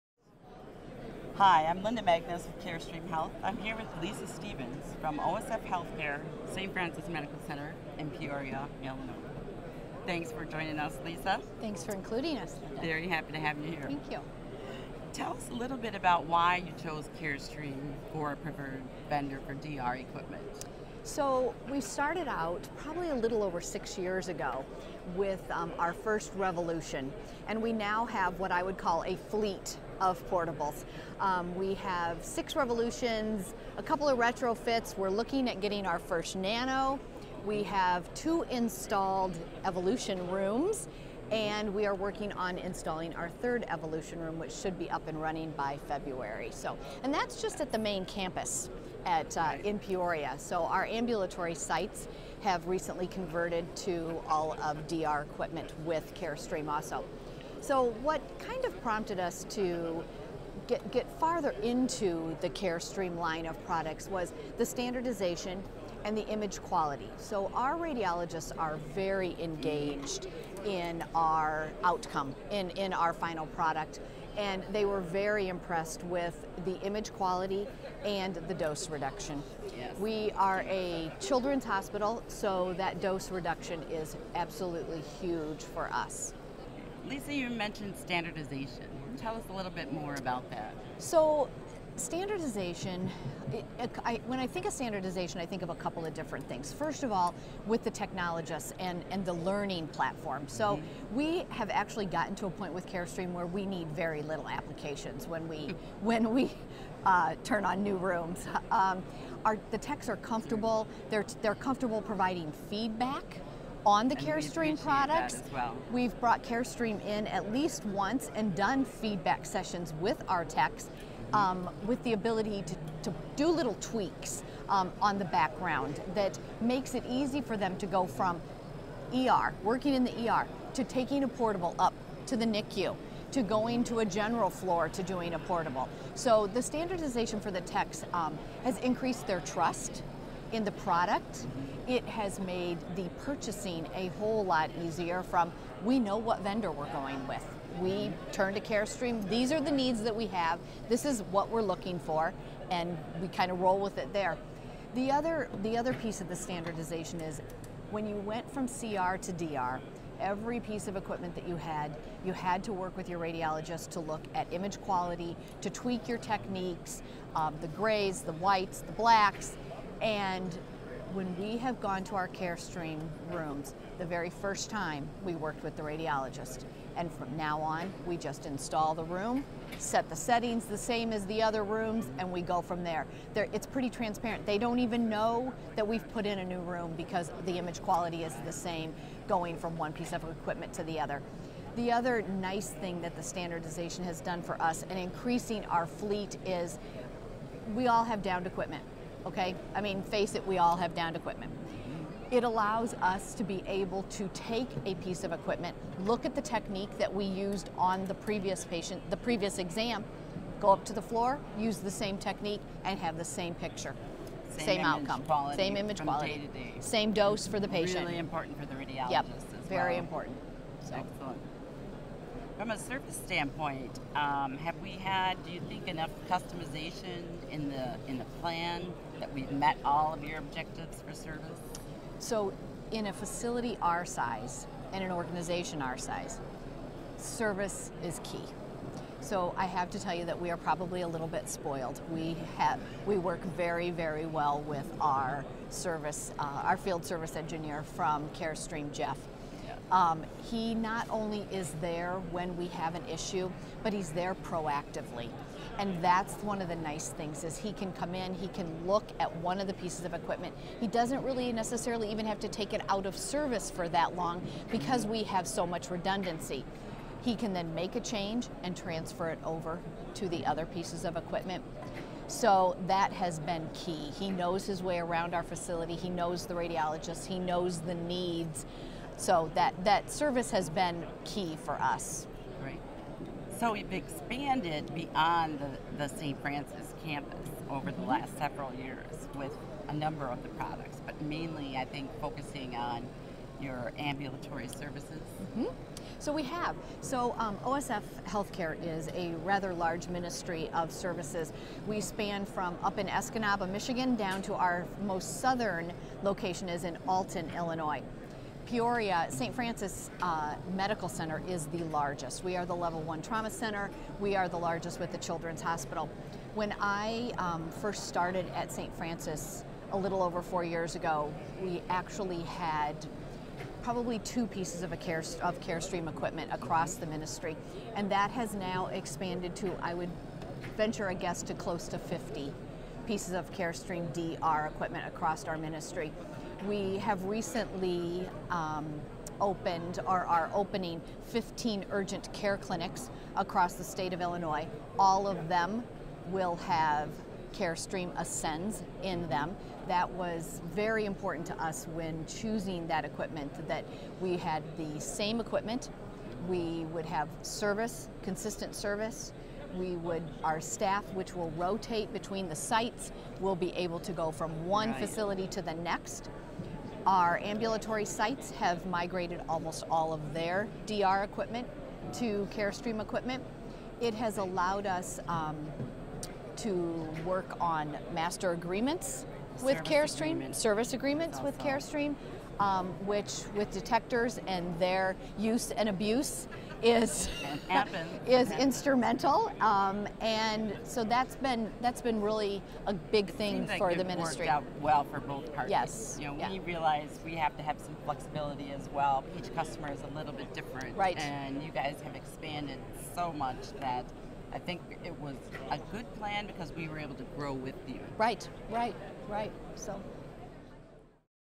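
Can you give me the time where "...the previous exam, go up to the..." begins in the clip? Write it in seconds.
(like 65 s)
209 s.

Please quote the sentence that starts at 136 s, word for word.
So the standardization for the techs um, has increased their trust in the product.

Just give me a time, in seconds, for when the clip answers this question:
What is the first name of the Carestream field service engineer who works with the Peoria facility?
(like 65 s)
248 s.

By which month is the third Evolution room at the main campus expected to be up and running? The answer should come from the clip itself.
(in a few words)
February.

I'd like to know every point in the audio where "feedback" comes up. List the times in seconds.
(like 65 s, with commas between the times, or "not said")
112 s, 119 s.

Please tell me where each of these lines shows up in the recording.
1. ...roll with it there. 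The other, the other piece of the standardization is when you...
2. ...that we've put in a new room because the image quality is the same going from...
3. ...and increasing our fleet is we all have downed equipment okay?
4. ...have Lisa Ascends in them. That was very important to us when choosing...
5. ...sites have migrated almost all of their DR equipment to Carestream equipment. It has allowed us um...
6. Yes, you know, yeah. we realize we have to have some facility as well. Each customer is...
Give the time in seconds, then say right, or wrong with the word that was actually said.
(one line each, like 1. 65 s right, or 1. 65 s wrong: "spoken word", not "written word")
1. 153 s right
2. 185 s right
3. 194 s right
4. 346 s wrong: "Carestream", not "Lisa"
5. 368 s right
6. 395 s wrong: "flexibility", not "facility".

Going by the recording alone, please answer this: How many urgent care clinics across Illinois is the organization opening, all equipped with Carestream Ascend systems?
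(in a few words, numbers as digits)
15.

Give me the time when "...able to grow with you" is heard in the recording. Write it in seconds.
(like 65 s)
406 s.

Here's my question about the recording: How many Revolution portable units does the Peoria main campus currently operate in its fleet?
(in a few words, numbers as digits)
6.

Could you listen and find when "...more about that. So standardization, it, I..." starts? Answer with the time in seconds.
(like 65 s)
89 s.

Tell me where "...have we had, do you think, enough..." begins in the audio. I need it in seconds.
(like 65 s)
224 s.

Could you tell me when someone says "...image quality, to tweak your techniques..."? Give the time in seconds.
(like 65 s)
164 s.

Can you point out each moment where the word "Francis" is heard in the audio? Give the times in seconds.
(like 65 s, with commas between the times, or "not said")
6 s, 286 s, 309 s, 318 s.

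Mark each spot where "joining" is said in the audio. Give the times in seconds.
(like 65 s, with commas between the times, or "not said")
10 s.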